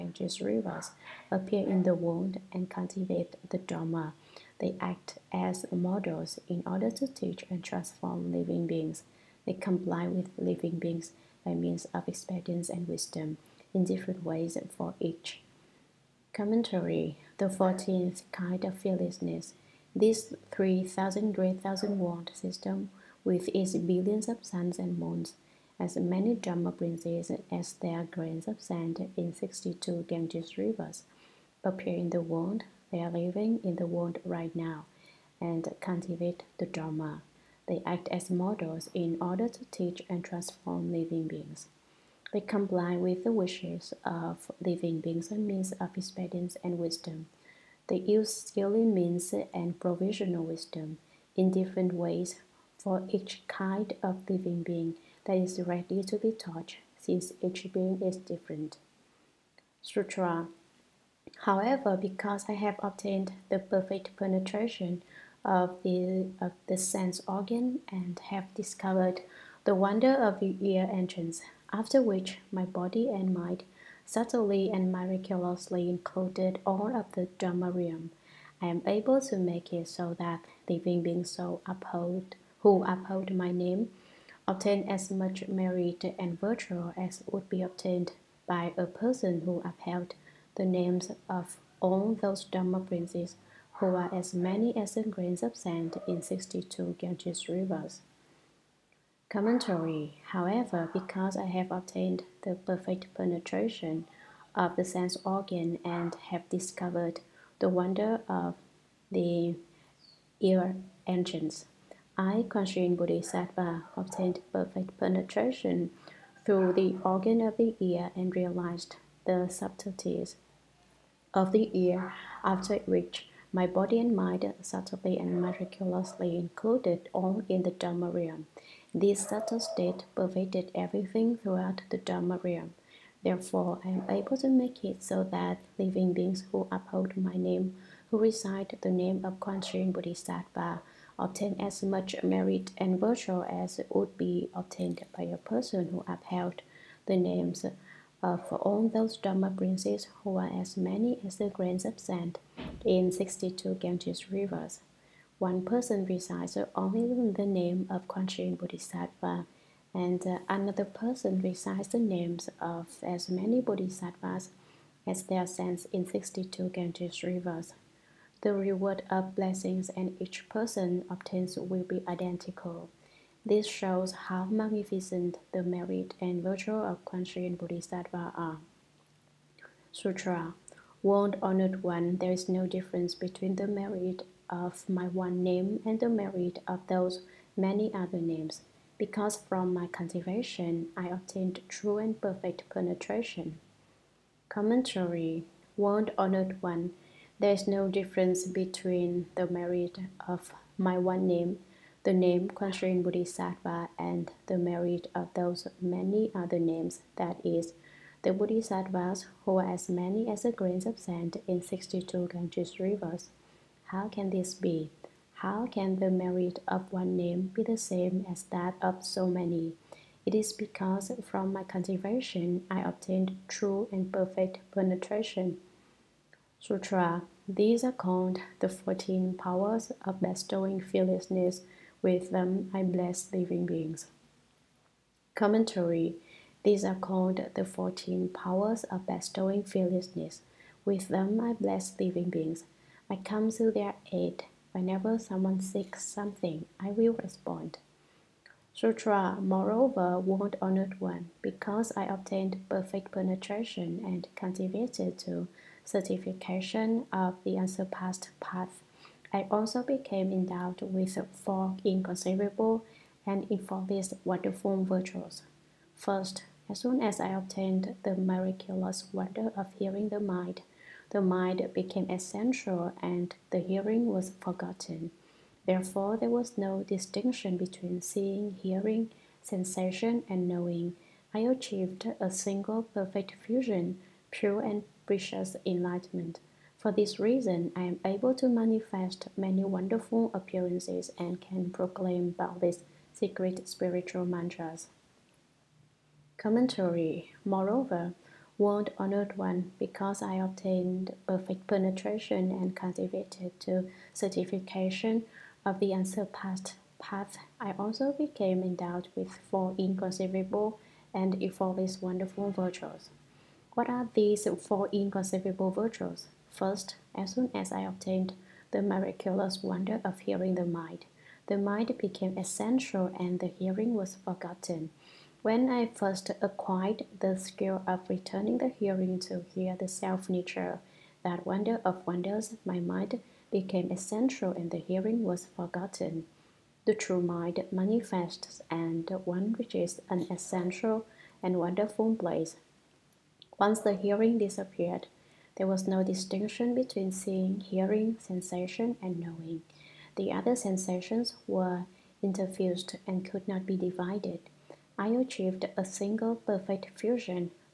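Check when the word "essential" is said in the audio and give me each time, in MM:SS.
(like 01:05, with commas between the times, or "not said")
04:32, 05:22, 05:33, 05:40.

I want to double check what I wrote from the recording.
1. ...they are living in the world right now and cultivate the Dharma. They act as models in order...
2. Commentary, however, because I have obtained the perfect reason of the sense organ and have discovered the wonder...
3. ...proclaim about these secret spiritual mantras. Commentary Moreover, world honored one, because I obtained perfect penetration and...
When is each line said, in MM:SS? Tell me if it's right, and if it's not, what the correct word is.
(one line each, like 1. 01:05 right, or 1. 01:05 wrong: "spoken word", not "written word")
1. 00:32 right
2. 01:39 wrong: "penetration", not "reason"
3. 04:51 right.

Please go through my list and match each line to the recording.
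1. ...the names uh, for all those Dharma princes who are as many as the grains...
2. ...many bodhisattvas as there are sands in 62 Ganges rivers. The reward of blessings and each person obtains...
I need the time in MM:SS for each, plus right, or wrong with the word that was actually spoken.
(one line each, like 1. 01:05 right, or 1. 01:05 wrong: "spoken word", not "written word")
1. 02:27 right
2. 02:43 right.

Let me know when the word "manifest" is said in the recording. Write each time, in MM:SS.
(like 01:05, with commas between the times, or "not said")
04:48, 05:37.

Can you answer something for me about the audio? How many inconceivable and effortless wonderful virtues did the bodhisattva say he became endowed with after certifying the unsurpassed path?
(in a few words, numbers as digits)
4.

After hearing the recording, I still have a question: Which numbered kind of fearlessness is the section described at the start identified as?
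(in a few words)
14th.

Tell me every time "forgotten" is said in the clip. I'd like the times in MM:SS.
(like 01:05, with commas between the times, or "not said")
04:34, 05:24, 05:35.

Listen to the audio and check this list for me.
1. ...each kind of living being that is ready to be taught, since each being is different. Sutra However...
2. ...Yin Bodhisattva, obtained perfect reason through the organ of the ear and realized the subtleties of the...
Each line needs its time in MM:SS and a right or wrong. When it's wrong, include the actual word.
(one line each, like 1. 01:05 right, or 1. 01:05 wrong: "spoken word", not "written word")
1. 00:53 right
2. 01:52 wrong: "penetration", not "reason".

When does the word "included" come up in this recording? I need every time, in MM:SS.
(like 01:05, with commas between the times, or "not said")
01:15, 02:06.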